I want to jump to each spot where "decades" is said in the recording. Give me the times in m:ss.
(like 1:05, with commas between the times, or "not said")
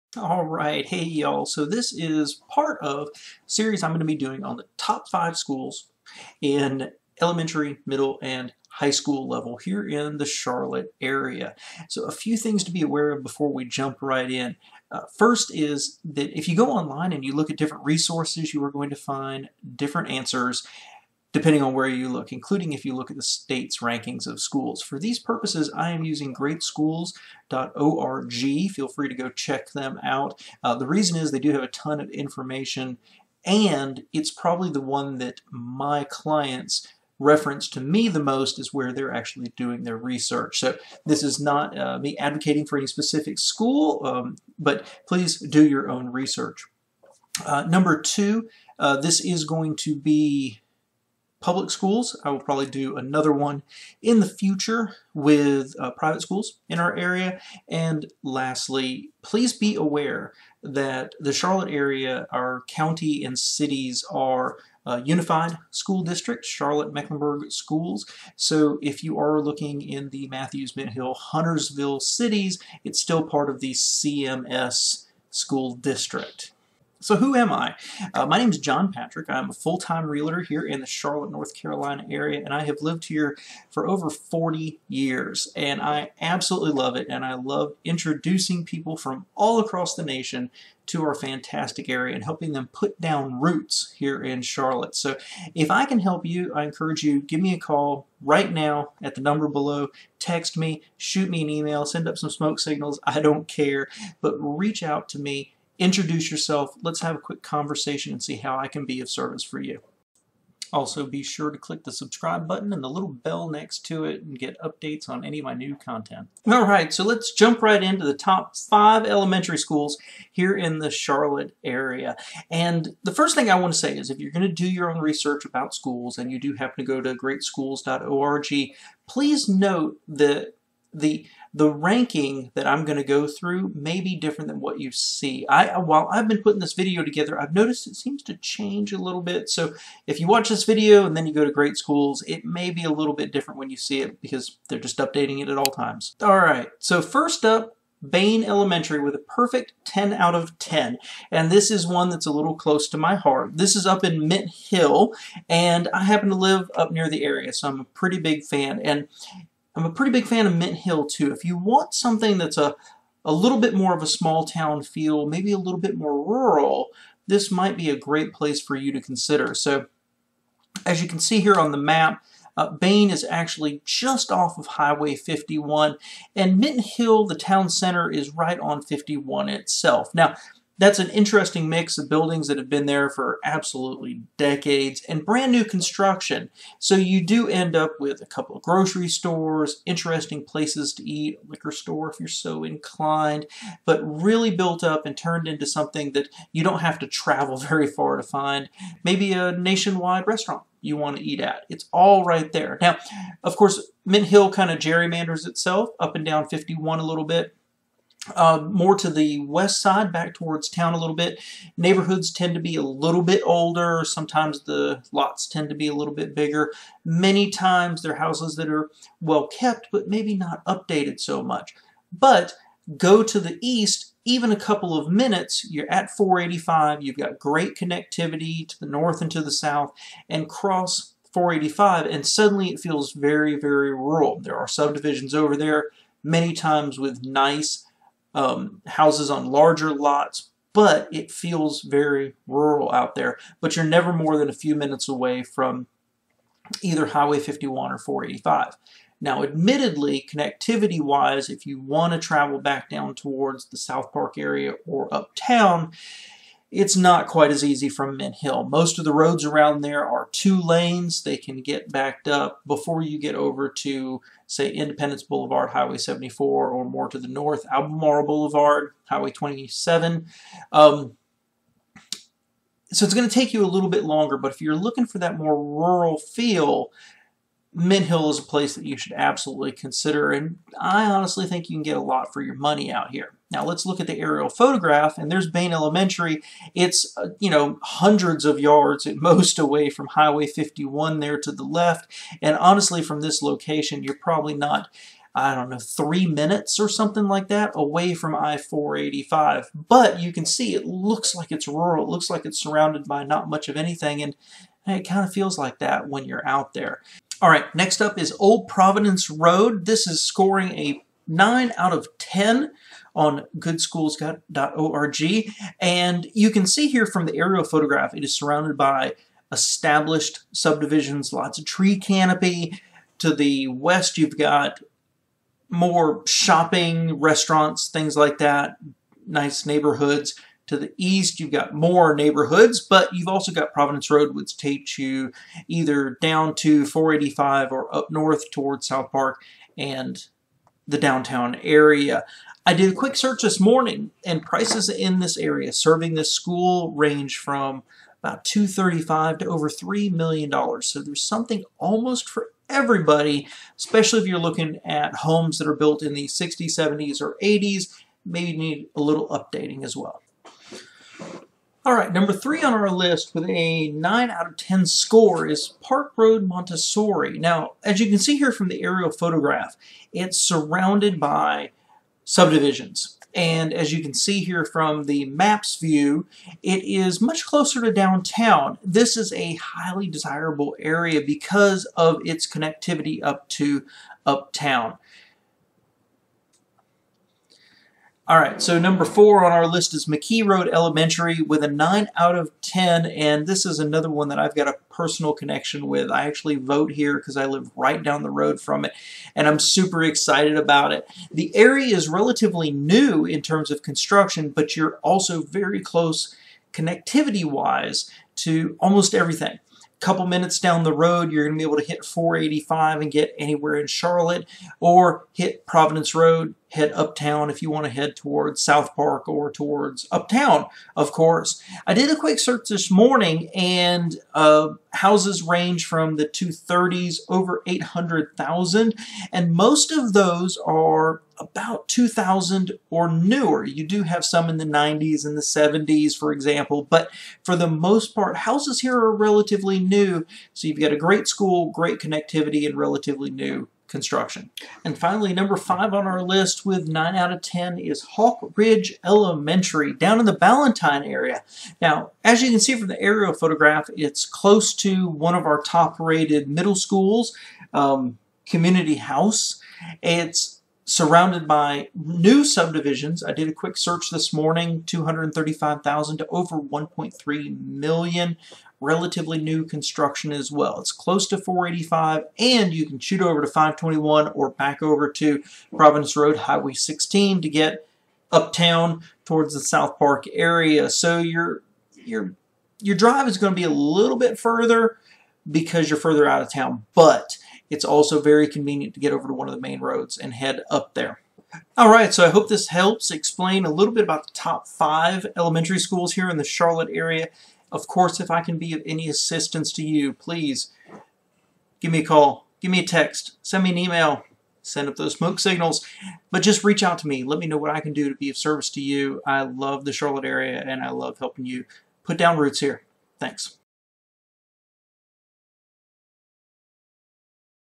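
3:04.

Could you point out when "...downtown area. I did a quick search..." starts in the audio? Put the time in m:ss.
5:40.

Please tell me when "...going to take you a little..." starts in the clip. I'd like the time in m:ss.
4:33.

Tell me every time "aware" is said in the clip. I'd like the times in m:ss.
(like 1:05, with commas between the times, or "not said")
0:12, 0:59.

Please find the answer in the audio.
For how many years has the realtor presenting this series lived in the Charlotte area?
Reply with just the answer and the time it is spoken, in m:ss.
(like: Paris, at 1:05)
over 40 years, at 1:23.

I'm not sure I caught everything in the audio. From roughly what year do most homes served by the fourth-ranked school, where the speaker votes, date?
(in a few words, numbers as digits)
2000.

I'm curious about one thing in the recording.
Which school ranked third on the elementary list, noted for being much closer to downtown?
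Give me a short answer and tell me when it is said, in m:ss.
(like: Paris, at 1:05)
Park Road Montessori, at 6:05.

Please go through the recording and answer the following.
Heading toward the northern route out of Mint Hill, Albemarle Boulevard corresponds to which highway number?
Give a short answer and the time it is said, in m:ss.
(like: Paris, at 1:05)
Highway 27, at 4:29.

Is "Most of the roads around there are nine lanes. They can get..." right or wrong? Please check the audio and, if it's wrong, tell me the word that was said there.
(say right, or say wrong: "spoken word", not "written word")
wrong: "two", not "nine".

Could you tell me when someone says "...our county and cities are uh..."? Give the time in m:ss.
1:02.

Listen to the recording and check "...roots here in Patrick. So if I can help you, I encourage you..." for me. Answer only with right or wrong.
wrong.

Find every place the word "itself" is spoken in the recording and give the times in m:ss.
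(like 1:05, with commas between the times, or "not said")
2:59, 3:25.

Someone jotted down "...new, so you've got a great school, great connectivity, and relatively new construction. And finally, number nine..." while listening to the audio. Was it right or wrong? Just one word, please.
wrong.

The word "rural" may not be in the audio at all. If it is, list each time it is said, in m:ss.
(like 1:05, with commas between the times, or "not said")
2:46, 3:53, 4:02, 4:35, 5:01.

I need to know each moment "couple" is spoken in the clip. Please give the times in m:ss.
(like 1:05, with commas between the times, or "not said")
3:08, 3:44, 6:49.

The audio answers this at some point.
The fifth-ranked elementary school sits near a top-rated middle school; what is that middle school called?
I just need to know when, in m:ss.
7:38.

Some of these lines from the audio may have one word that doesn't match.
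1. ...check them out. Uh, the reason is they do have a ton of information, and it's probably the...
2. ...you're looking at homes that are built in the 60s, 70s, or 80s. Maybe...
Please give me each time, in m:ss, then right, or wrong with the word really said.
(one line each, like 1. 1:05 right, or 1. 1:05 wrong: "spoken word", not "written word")
1. 0:29 right
2. 5:54 right.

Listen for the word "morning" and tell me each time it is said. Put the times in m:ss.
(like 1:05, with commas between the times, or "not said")
5:43, 7:02, 7:44.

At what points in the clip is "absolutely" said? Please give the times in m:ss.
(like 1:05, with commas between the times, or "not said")
1:26, 3:03, 4:39.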